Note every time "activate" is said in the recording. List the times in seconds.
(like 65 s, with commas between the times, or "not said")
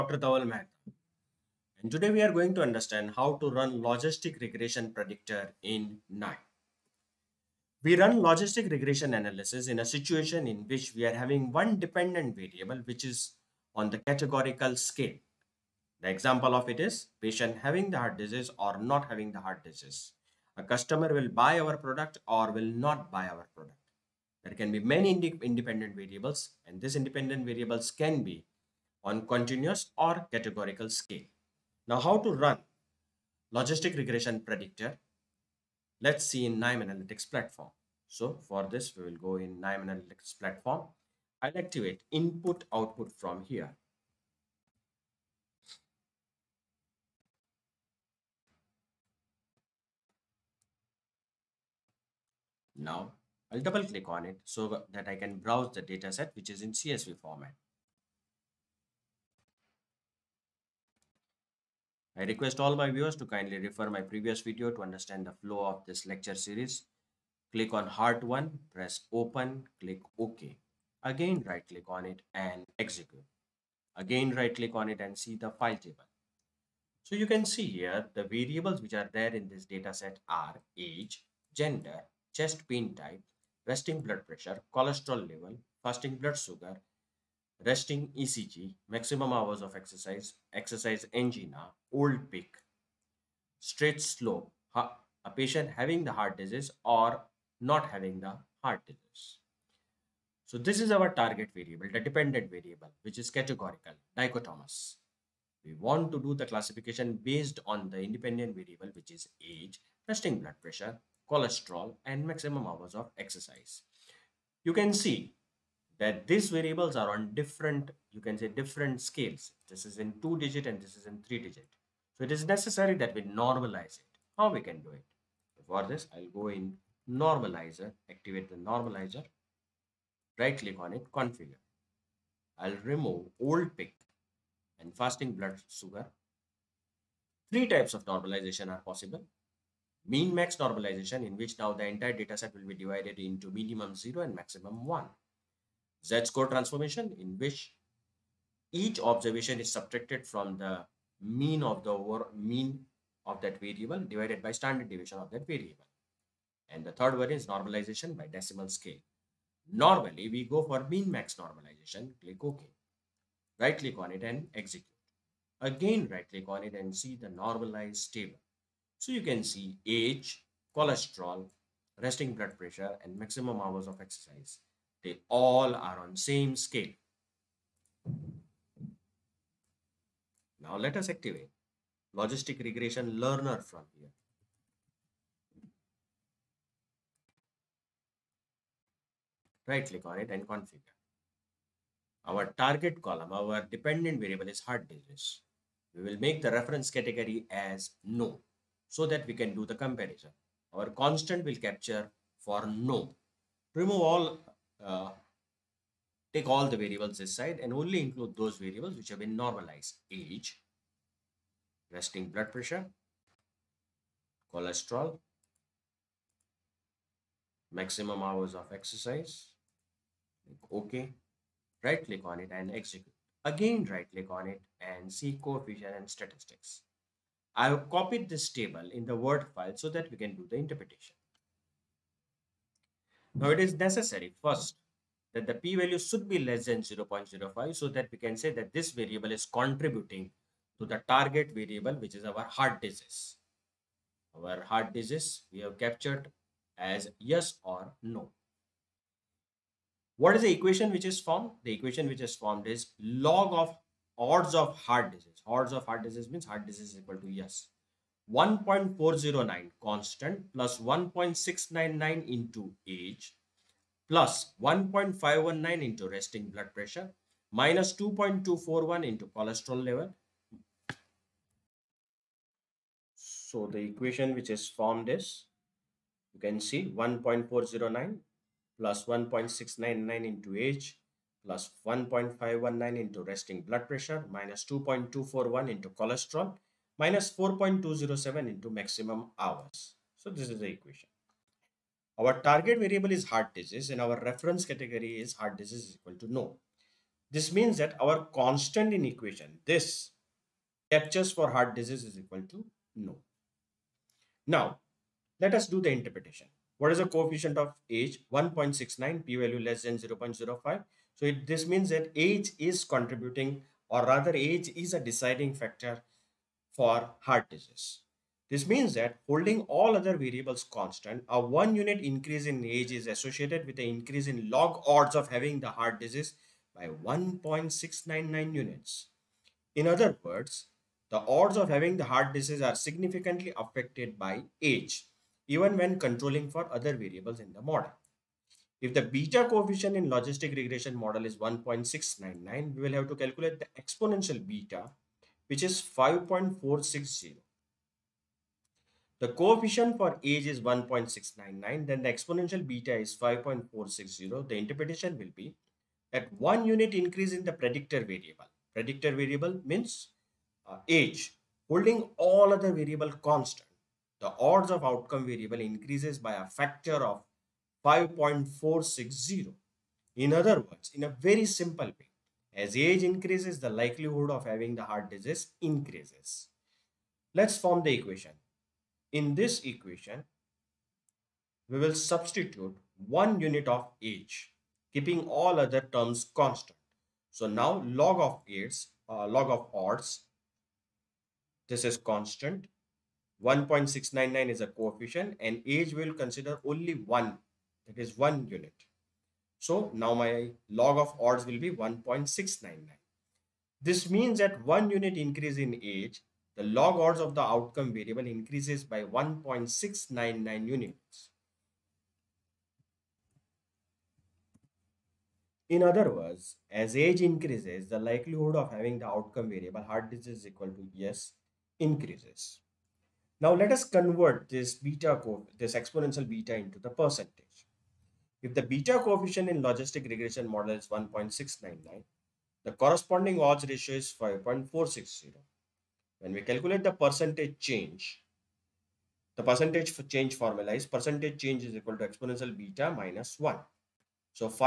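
41 s, 128 s, 181 s.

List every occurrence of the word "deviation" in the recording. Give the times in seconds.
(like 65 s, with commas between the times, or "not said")
154 s.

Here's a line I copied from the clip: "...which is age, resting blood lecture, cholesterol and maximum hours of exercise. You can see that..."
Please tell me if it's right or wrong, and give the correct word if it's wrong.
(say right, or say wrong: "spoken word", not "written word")
wrong: "pressure", not "lecture".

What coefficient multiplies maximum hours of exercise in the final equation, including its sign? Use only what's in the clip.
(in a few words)
-4.207.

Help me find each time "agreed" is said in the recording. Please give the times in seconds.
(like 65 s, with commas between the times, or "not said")
not said.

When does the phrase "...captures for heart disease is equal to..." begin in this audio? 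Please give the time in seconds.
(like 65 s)
300 s.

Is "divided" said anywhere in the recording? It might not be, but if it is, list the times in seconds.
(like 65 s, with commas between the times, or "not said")
142 s, 154 s.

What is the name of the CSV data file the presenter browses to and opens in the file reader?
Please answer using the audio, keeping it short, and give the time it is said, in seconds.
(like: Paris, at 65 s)
Heart 1, at 67 s.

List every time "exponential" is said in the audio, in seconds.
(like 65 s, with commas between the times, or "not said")
343 s, 352 s, 425 s, 442 s.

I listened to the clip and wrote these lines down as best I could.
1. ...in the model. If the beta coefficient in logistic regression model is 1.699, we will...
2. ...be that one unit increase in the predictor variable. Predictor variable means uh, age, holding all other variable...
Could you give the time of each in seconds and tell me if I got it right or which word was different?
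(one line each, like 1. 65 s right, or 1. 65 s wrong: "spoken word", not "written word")
1. 337 s right
2. 355 s right.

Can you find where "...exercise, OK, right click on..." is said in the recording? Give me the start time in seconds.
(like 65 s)
218 s.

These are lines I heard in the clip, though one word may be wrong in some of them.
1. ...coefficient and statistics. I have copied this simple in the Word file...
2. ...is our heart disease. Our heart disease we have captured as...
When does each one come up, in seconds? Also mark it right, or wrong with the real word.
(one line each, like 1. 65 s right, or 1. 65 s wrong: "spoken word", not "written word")
1. 225 s wrong: "table", not "simple"
2. 242 s right.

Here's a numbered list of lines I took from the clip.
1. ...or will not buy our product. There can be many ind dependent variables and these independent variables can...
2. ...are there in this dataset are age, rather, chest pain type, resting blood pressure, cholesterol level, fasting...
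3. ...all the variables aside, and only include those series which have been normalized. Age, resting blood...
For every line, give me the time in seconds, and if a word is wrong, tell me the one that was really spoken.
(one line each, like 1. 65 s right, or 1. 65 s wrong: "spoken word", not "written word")
1. 22 s wrong: "independent", not "dependent"
2. 78 s wrong: "gender", not "rather"
3. 206 s wrong: "variables", not "series".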